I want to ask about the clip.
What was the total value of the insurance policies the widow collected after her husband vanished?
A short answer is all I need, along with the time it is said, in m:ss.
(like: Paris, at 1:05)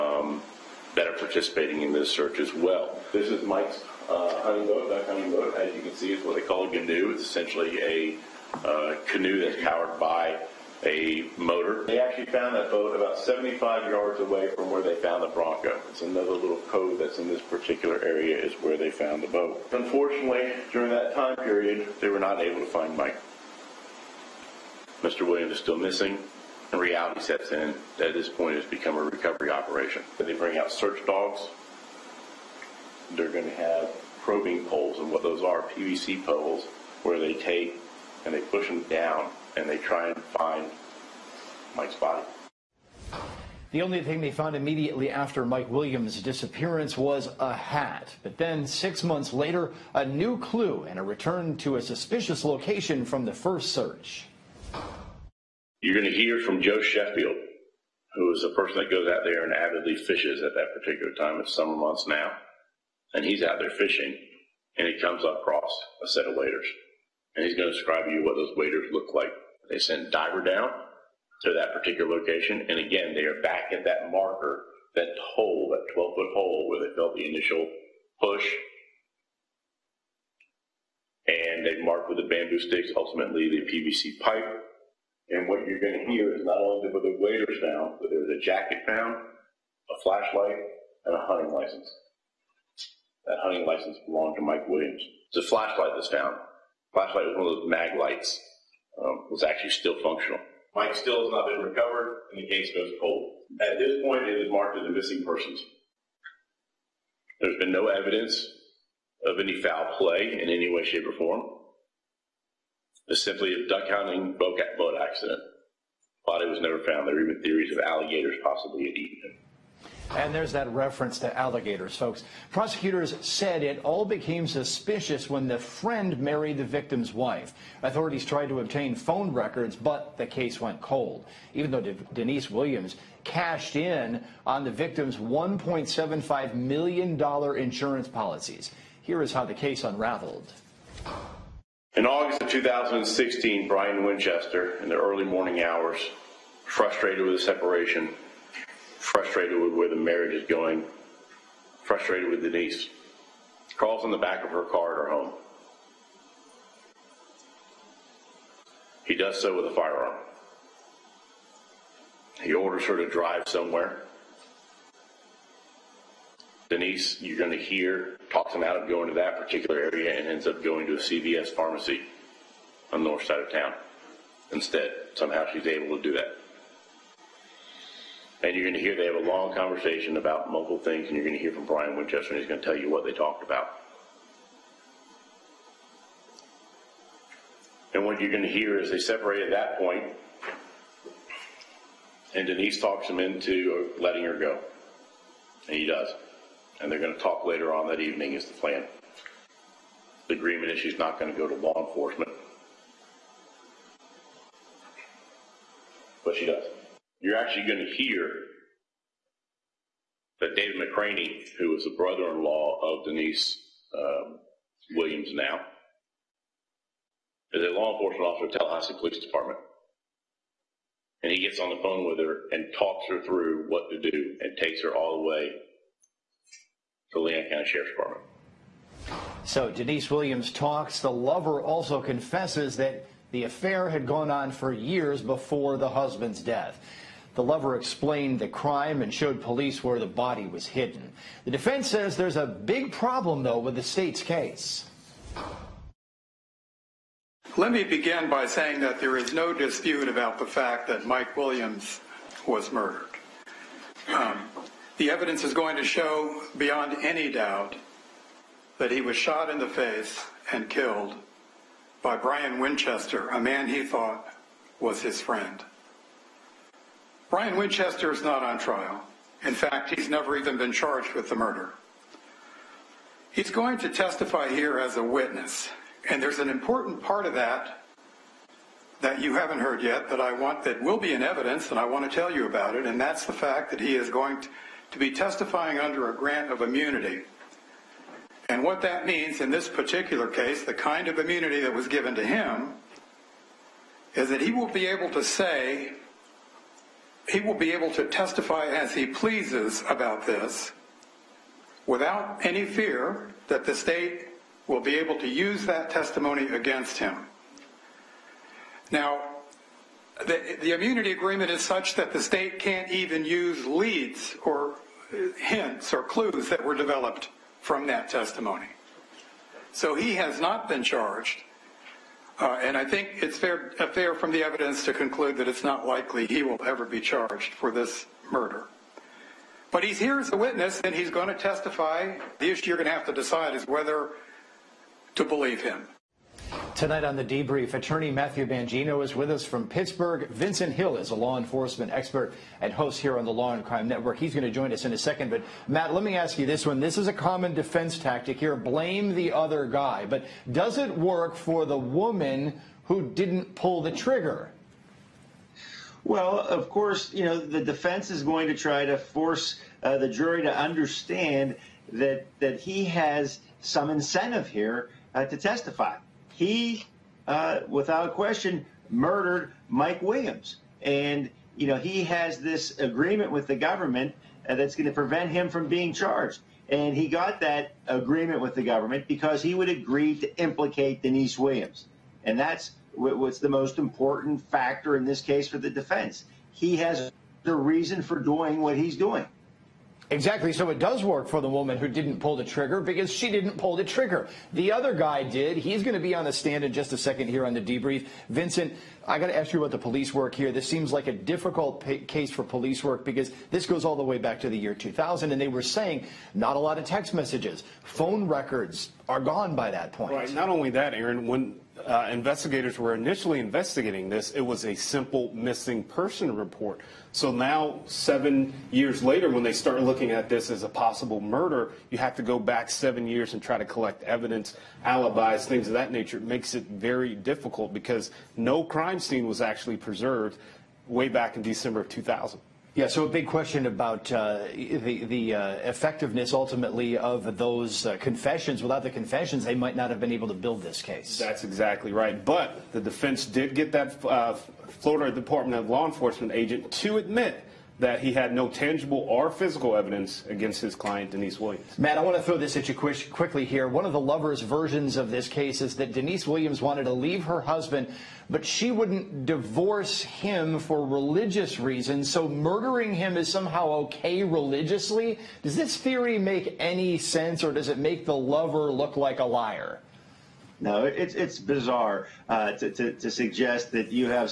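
$1.75 million, at 2:15.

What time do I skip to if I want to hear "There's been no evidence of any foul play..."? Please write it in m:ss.
1:47.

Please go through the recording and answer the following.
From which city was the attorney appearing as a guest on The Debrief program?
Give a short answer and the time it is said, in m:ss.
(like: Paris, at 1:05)
Pittsburgh, at 5:39.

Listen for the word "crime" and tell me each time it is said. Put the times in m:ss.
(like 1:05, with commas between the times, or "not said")
3:58, 5:43, 7:08.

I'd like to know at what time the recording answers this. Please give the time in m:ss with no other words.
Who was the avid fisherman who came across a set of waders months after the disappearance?
0:56.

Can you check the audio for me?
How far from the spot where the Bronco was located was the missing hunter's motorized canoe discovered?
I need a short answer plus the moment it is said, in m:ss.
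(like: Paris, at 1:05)
75 yards, at 0:13.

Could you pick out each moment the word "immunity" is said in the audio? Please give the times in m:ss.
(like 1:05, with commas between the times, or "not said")
4:46, 4:51, 5:10.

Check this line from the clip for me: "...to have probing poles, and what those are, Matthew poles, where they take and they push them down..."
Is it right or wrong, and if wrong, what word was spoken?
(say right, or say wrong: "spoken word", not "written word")
wrong: "PVC", not "Matthew".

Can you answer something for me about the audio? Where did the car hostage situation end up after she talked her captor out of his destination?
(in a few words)
CVS pharmacy.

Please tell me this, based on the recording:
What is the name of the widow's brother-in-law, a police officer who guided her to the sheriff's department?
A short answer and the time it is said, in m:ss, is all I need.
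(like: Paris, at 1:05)
David McCraney, at 3:30.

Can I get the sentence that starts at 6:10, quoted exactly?
And, you know, he has this agreement with the government uh, that's going to prevent him from being charged.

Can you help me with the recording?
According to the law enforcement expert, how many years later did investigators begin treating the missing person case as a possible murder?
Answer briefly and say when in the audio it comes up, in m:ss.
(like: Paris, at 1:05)
7, at 6:57.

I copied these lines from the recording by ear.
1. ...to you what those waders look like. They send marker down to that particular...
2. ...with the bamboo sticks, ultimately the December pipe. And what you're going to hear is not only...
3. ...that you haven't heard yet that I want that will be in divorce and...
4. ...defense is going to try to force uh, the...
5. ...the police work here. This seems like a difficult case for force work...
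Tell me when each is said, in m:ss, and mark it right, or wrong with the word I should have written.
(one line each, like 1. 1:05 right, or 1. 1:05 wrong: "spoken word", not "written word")
1. 1:08 wrong: "diver", not "marker"
2. 1:22 wrong: "PVC", not "December"
3. 4:38 wrong: "evidence", not "divorce"
4. 5:57 right
5. 6:39 wrong: "police", not "force".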